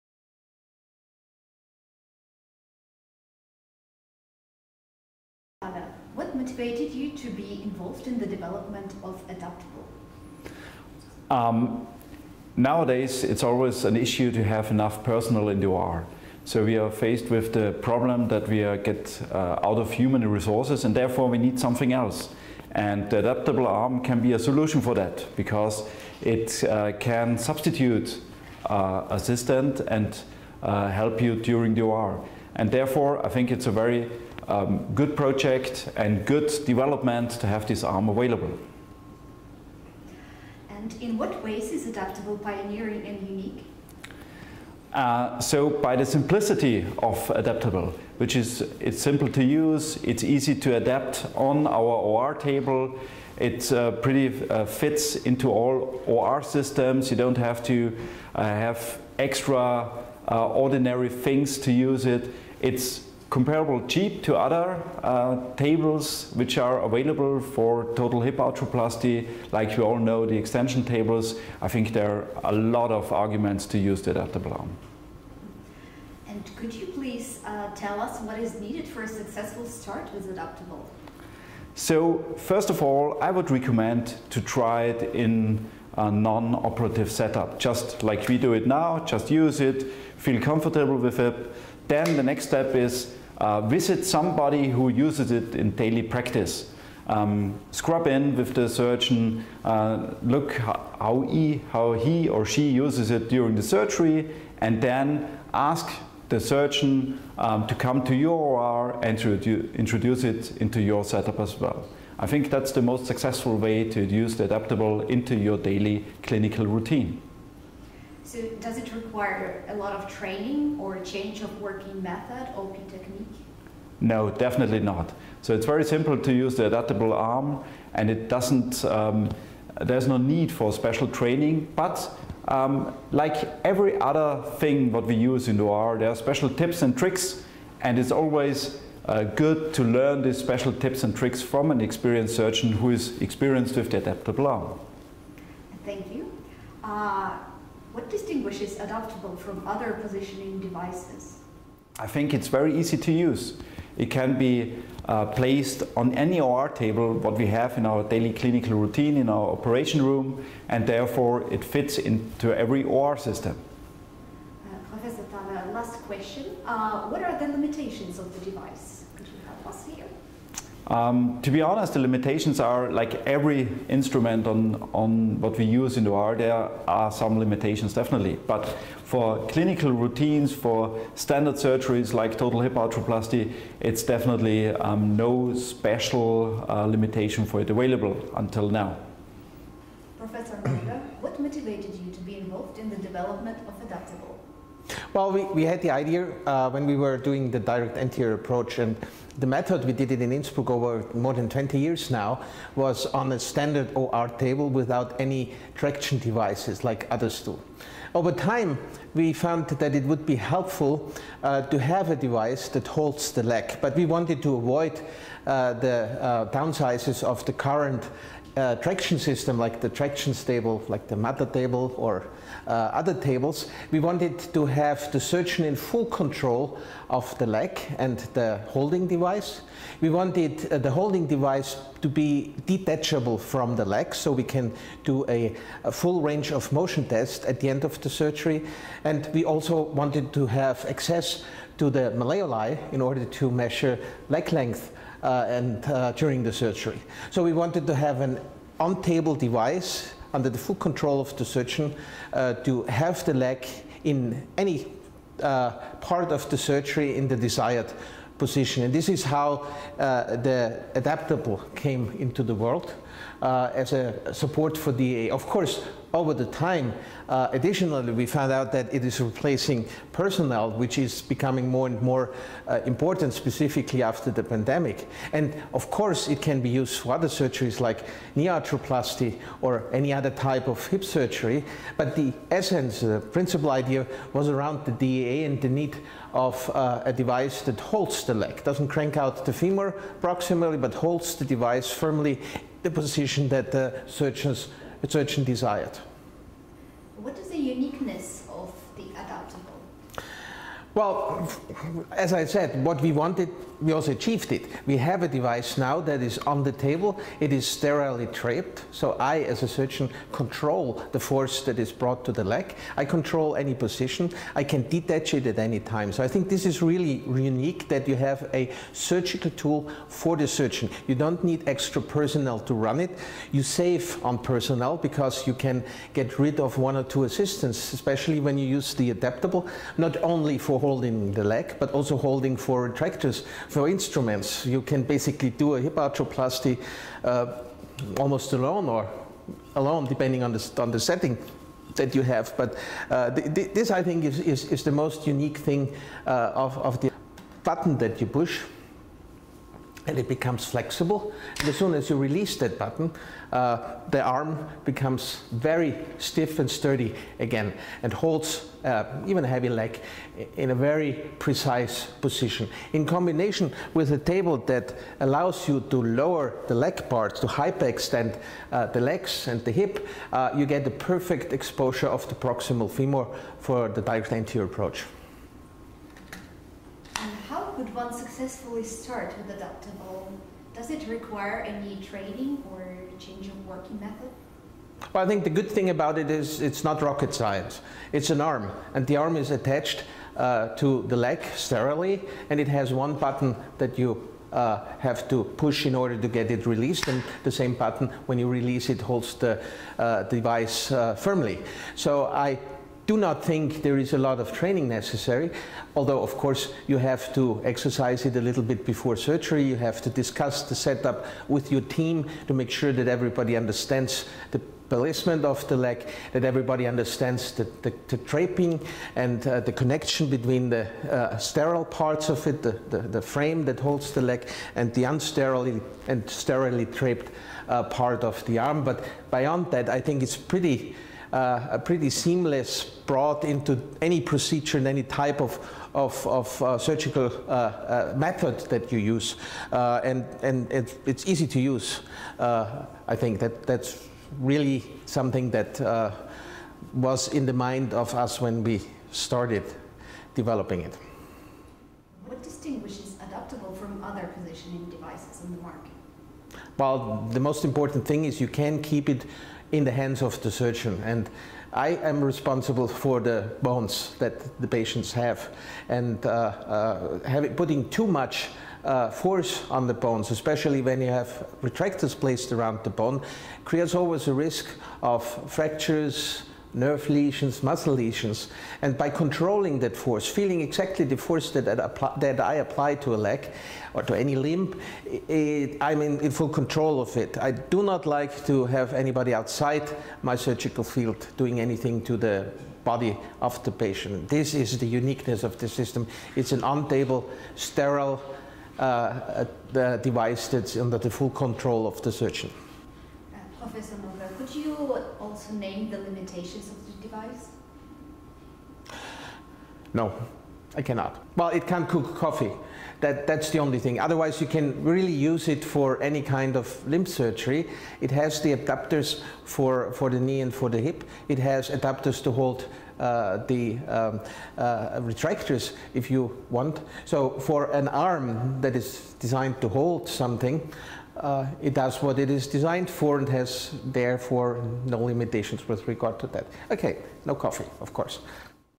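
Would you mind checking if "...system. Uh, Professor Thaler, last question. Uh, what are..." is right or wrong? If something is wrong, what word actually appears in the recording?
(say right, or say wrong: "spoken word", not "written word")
right.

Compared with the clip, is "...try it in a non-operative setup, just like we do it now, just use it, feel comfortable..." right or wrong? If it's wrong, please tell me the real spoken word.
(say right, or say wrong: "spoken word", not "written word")
right.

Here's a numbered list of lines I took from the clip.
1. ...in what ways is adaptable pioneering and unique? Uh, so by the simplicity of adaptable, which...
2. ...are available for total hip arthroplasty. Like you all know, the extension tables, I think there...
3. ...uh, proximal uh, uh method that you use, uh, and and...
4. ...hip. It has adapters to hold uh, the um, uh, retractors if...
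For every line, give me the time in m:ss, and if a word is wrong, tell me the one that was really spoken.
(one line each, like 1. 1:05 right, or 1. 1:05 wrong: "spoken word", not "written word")
1. 0:41 right
2. 1:06 right
3. 7:16 wrong: "surgical", not "proximal"
4. 8:40 right.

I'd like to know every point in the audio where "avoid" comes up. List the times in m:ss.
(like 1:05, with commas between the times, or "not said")
3:34.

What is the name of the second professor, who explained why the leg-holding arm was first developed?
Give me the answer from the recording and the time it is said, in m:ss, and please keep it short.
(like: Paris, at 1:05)
Rega, at 3:10.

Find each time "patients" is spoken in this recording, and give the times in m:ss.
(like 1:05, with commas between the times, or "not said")
7:44, 8:13.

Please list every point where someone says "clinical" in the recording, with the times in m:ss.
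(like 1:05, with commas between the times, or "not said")
1:56, 2:38, 2:59.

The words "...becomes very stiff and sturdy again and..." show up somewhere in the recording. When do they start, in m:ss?
5:54.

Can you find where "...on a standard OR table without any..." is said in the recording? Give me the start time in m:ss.
3:23.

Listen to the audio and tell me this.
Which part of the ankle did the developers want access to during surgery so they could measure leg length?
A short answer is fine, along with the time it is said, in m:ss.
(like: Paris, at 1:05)
malleoli, at 4:02.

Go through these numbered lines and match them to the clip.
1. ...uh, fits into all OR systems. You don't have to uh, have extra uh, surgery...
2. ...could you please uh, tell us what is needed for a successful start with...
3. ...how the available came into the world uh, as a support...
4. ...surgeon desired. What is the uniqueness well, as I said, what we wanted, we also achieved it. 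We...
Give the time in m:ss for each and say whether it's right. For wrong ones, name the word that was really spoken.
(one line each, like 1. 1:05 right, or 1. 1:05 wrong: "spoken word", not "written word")
1. 0:54 wrong: "ordinary", not "surgery"
2. 1:16 right
3. 4:19 wrong: "adaptable", not "available"
4. 4:55 right.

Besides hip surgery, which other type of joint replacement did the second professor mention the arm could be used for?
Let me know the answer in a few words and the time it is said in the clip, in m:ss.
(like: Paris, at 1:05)
knee arthroplasty, at 4:38.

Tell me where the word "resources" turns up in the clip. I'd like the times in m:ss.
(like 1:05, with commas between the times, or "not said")
0:20.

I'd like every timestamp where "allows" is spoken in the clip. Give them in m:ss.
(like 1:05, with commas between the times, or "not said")
6:05.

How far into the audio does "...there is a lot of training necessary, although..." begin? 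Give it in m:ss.
6:43.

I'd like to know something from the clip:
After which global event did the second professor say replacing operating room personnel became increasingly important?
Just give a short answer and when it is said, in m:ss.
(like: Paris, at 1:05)
the pandemic, at 4:34.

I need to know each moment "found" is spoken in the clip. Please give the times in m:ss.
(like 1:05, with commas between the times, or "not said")
3:29, 4:28.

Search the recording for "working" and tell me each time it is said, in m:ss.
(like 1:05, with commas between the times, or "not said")
2:01, 6:23.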